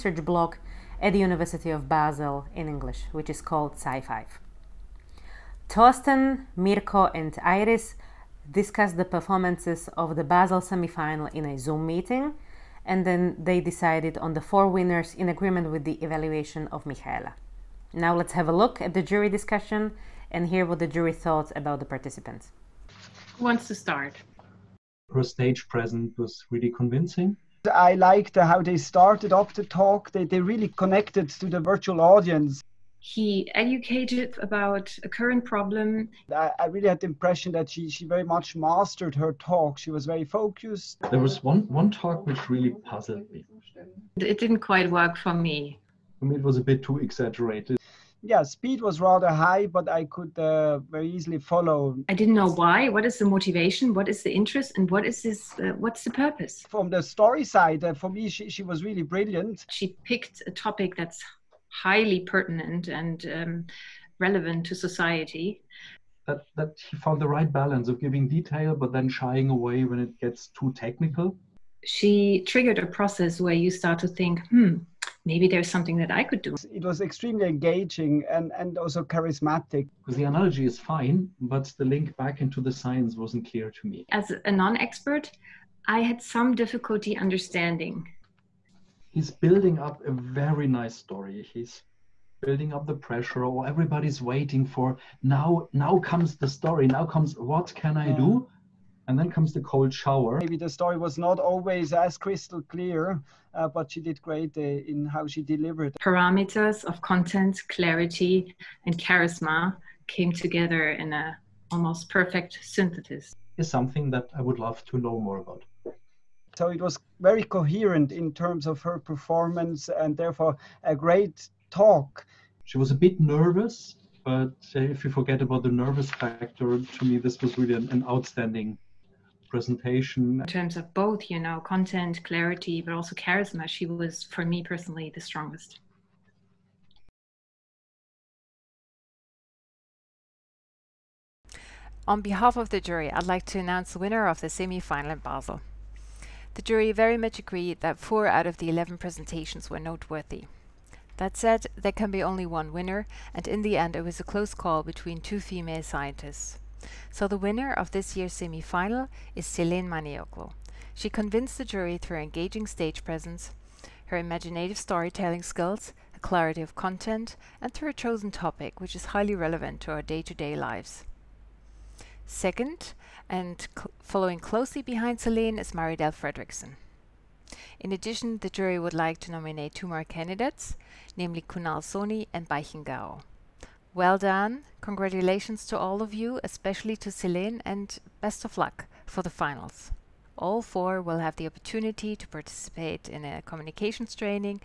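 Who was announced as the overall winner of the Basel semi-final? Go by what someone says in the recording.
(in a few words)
Selen Manioglu.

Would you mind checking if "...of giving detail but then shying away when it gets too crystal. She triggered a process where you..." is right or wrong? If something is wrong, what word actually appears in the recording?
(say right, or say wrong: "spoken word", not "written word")
wrong: "technical", not "crystal".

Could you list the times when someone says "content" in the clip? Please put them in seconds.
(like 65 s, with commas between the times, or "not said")
107 s, 131 s, 166 s.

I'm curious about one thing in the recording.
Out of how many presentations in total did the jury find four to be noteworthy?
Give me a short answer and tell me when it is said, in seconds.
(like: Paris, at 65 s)
11, at 148 s.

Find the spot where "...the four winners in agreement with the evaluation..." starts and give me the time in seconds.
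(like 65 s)
14 s.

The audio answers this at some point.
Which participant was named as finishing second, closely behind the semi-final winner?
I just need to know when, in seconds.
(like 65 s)
175 s.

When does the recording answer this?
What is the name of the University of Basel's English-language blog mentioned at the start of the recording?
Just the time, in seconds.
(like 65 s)
3 s.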